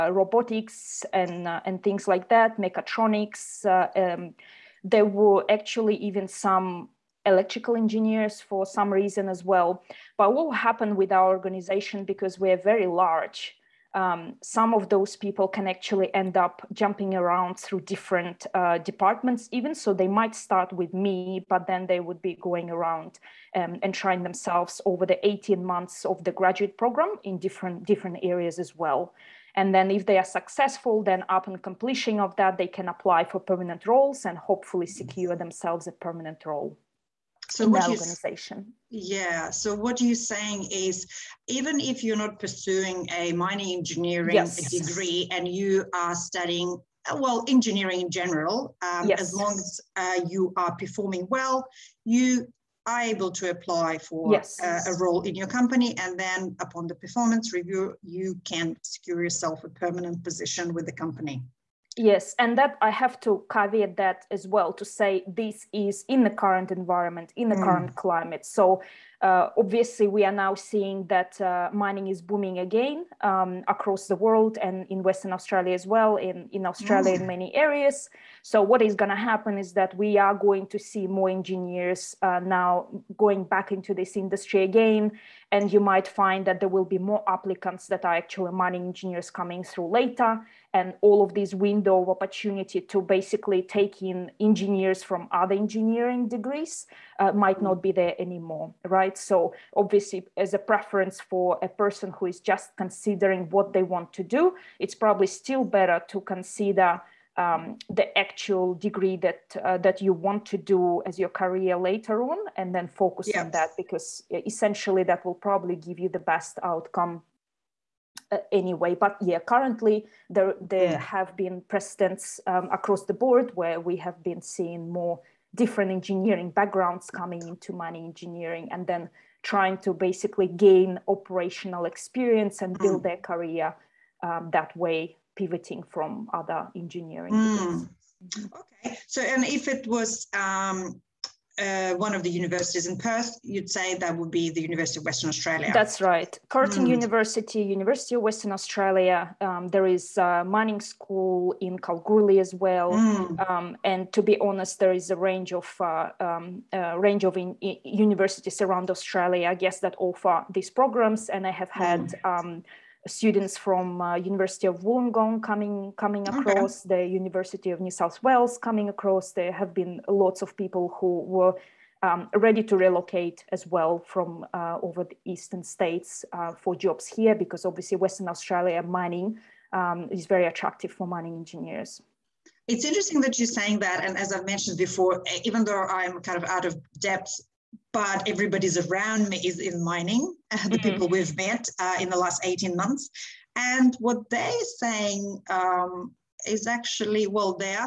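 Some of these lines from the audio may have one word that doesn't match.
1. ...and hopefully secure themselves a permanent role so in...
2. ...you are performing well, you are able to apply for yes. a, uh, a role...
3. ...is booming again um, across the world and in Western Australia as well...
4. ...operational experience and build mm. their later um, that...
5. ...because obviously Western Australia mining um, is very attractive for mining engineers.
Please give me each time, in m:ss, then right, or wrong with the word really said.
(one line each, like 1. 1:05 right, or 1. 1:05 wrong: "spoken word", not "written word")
1. 0:34 right
2. 0:50 right
3. 1:12 right
4. 2:11 wrong: "career", not "later"
5. 2:57 right.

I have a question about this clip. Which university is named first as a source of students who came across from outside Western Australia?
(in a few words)
University of Wollongong.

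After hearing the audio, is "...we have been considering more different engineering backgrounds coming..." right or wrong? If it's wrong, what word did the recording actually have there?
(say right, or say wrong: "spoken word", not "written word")
wrong: "seeing", not "considering".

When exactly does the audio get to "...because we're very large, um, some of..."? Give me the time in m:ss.
0:12.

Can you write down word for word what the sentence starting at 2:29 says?
Um, there is a mining school in Kalgoorlie as well.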